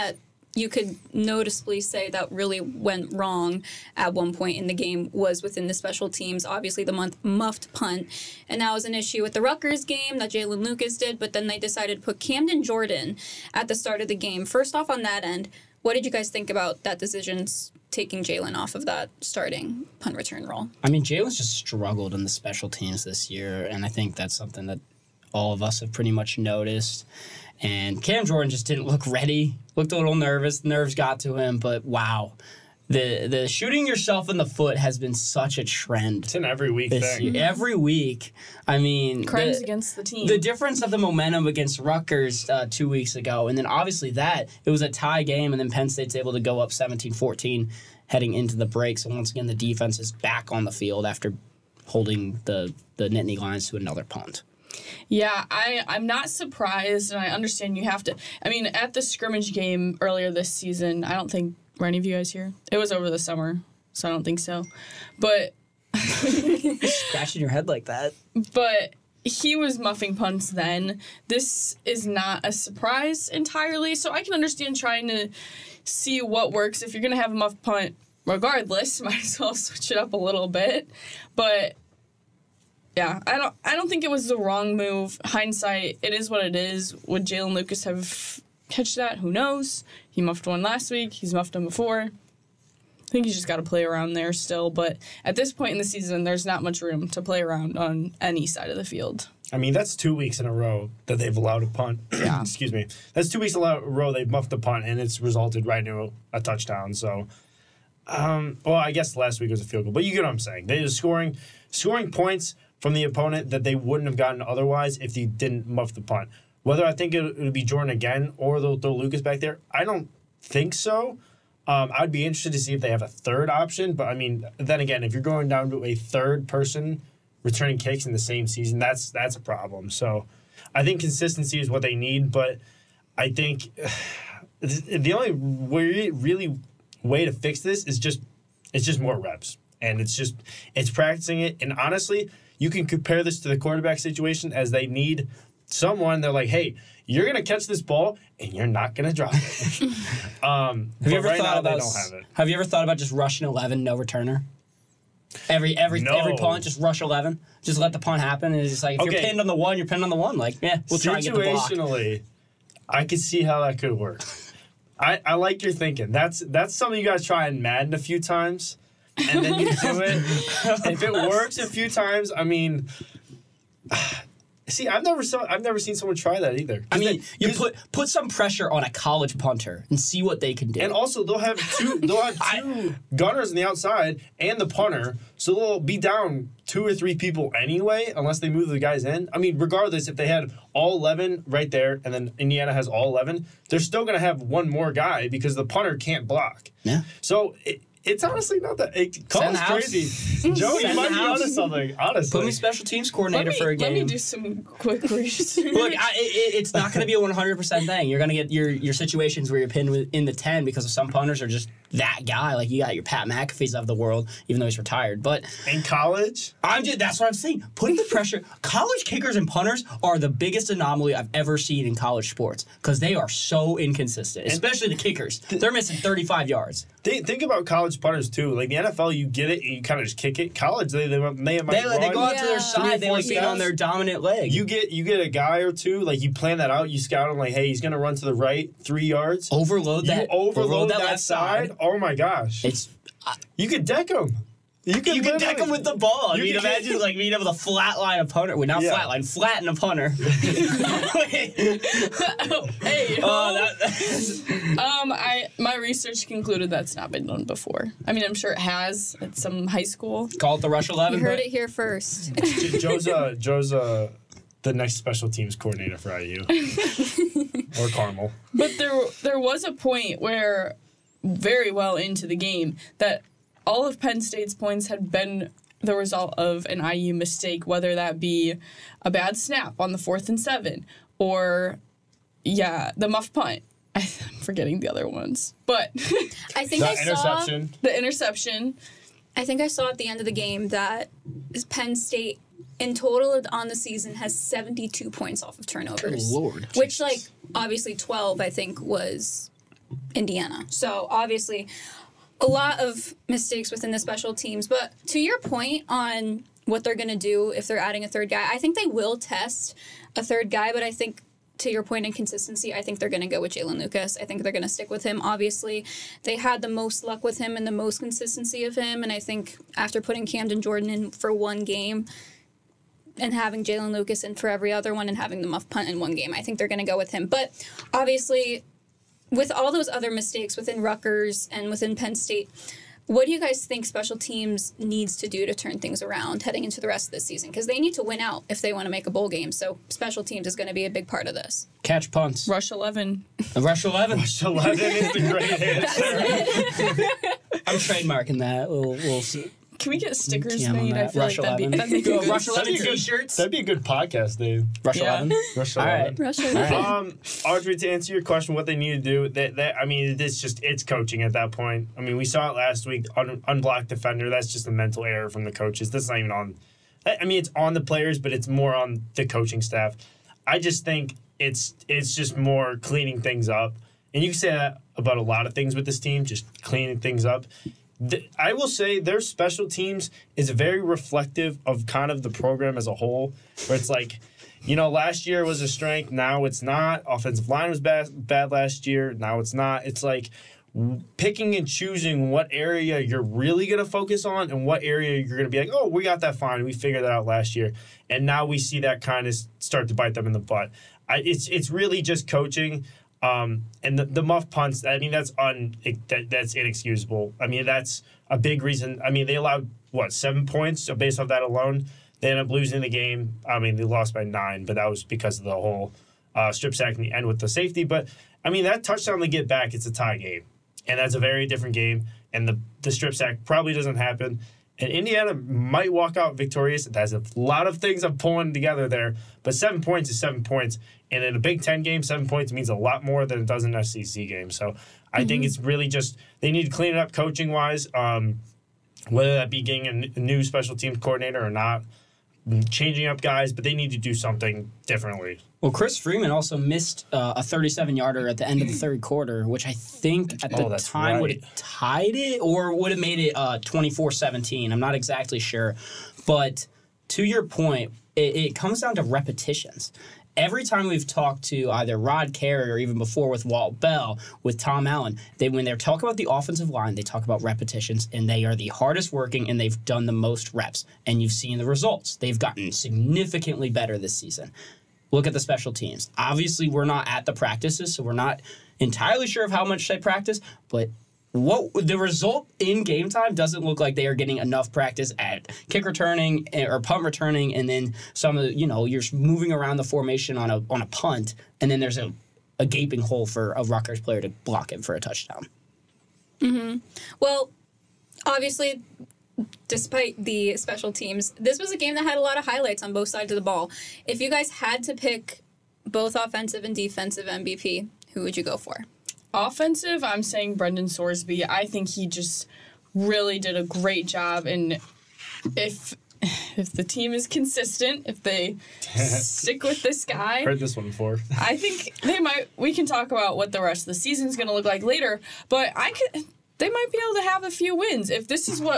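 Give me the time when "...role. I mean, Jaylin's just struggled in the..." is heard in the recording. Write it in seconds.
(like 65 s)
20 s.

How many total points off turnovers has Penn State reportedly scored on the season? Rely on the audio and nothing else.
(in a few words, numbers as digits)
72.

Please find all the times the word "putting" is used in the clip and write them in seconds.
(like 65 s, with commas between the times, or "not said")
217 s, 319 s.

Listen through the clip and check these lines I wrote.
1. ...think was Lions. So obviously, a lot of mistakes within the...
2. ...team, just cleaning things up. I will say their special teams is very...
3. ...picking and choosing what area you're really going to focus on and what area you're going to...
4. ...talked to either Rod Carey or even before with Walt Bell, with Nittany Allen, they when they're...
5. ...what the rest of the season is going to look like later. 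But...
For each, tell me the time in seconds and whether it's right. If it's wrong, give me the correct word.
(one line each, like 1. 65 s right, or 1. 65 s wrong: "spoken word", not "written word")
1. 298 s wrong: "Indiana", not "Lions"
2. 375 s right
3. 391 s right
4. 461 s wrong: "Tom", not "Nittany"
5. 523 s right.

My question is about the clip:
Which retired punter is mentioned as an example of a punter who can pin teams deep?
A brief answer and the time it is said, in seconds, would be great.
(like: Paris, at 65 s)
Pat McAfee, at 213 s.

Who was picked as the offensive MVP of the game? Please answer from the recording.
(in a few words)
Brendan Sorsby.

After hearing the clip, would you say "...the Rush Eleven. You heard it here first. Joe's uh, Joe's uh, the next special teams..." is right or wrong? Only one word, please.
right.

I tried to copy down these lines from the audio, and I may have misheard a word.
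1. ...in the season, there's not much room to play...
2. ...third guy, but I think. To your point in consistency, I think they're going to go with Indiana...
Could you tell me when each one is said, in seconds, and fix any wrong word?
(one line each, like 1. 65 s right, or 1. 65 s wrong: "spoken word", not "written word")
1. 95 s right
2. 310 s wrong: "Jaylin", not "Indiana".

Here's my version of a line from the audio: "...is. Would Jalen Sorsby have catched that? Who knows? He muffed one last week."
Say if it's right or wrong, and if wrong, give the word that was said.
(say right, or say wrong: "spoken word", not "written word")
wrong: "Lucas", not "Sorsby".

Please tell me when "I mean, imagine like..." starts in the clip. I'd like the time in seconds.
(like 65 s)
246 s.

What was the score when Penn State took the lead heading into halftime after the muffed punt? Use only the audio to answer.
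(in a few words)
17-14.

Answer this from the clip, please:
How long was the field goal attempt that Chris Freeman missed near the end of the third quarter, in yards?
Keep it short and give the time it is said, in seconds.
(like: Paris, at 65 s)
37, at 447 s.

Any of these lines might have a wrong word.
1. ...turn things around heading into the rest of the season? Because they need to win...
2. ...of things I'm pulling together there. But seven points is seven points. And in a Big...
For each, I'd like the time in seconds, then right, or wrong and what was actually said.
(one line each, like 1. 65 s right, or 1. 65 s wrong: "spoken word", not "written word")
1. 335 s right
2. 427 s right.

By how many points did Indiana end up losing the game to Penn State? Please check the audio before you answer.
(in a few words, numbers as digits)
9.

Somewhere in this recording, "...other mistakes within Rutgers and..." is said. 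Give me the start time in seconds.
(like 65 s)
329 s.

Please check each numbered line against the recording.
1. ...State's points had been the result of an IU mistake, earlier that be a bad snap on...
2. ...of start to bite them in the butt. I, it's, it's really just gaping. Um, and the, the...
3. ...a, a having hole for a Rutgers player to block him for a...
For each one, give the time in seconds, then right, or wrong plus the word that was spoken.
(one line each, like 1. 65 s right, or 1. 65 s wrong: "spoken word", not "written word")
1. 274 s wrong: "whether", not "earlier"
2. 399 s wrong: "coaching", not "gaping"
3. 491 s wrong: "gaping", not "having".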